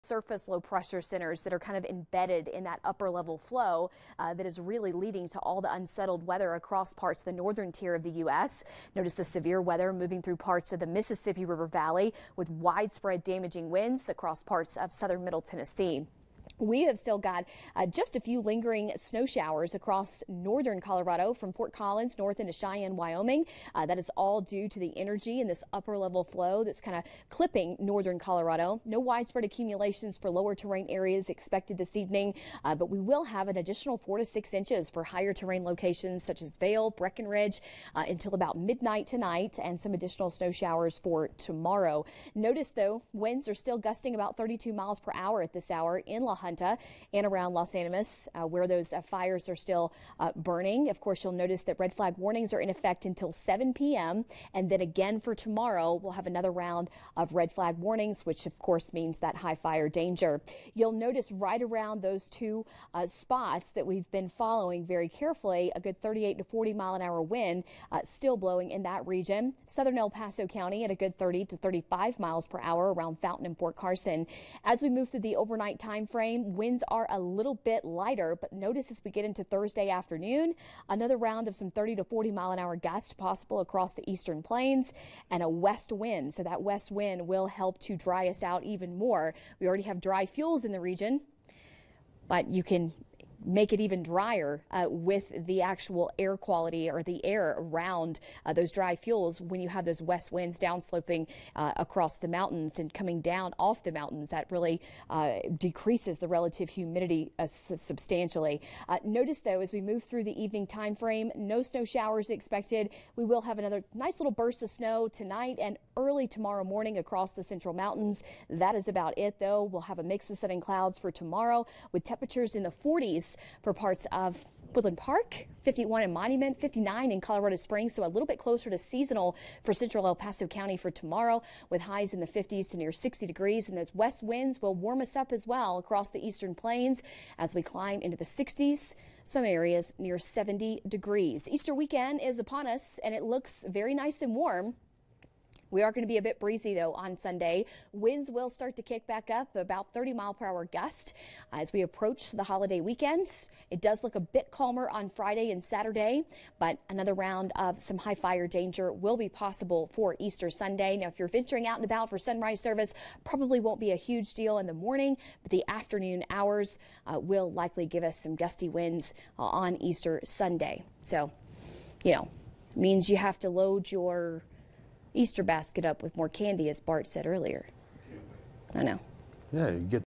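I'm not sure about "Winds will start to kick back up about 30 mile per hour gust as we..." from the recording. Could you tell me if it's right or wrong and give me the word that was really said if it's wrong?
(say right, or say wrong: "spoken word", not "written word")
right.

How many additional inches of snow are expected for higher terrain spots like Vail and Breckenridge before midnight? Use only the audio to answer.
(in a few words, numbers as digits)
4 to 6.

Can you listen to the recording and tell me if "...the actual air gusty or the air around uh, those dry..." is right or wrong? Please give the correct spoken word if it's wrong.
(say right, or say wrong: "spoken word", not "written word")
wrong: "quality", not "gusty".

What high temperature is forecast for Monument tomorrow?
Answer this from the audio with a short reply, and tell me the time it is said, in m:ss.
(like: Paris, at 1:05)
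51, at 2:05.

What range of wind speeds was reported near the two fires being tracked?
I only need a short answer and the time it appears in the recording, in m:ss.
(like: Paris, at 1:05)
38 to 40 mph, at 1:06.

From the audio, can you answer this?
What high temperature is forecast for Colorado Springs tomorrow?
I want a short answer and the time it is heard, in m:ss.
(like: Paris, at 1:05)
59, at 2:06.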